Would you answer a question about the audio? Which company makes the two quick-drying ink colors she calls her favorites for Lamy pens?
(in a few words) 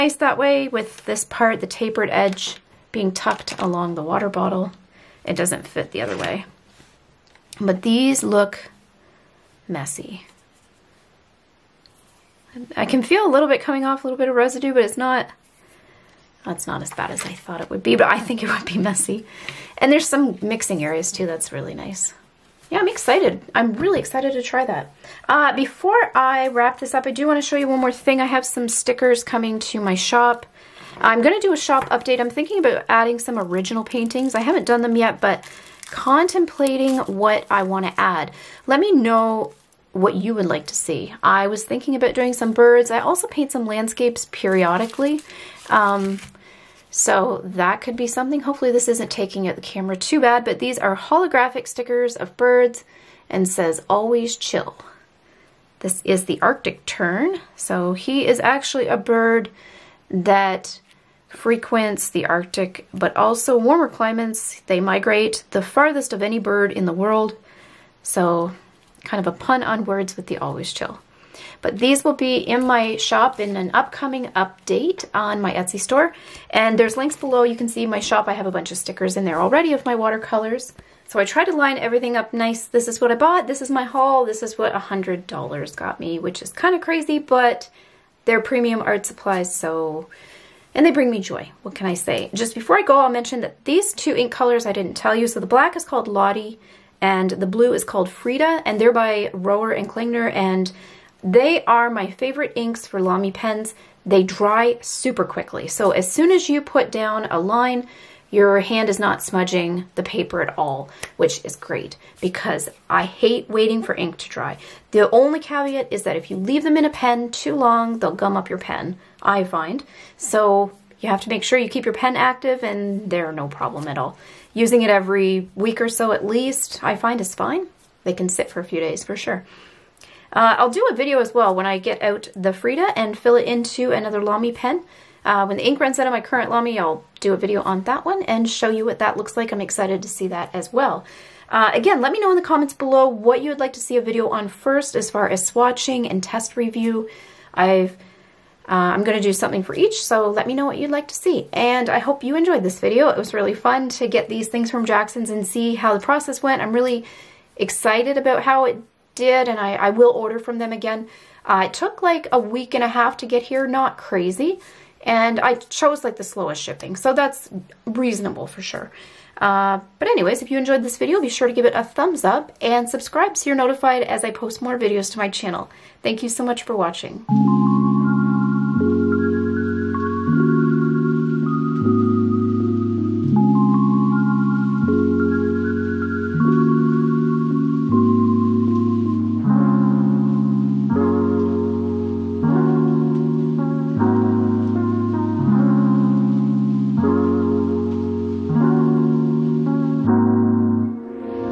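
Rohrer and Klingner.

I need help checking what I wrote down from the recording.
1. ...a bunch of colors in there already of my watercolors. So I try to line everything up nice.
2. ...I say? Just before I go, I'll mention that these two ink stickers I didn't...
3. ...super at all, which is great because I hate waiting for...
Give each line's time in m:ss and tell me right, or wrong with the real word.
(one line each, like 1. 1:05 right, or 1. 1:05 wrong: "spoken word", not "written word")
1. 1:18 wrong: "stickers", not "colors"
2. 1:31 wrong: "colors", not "stickers"
3. 1:50 wrong: "paper", not "super".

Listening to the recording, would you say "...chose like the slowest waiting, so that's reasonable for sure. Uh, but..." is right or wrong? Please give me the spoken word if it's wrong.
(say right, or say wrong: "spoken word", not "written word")
wrong: "shipping", not "waiting".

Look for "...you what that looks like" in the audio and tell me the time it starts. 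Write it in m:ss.
2:18.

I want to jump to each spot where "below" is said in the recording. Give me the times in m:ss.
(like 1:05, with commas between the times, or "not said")
1:17, 2:22.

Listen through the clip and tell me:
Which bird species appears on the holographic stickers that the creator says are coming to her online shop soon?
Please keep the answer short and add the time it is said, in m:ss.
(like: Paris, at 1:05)
Arctic tern, at 0:56.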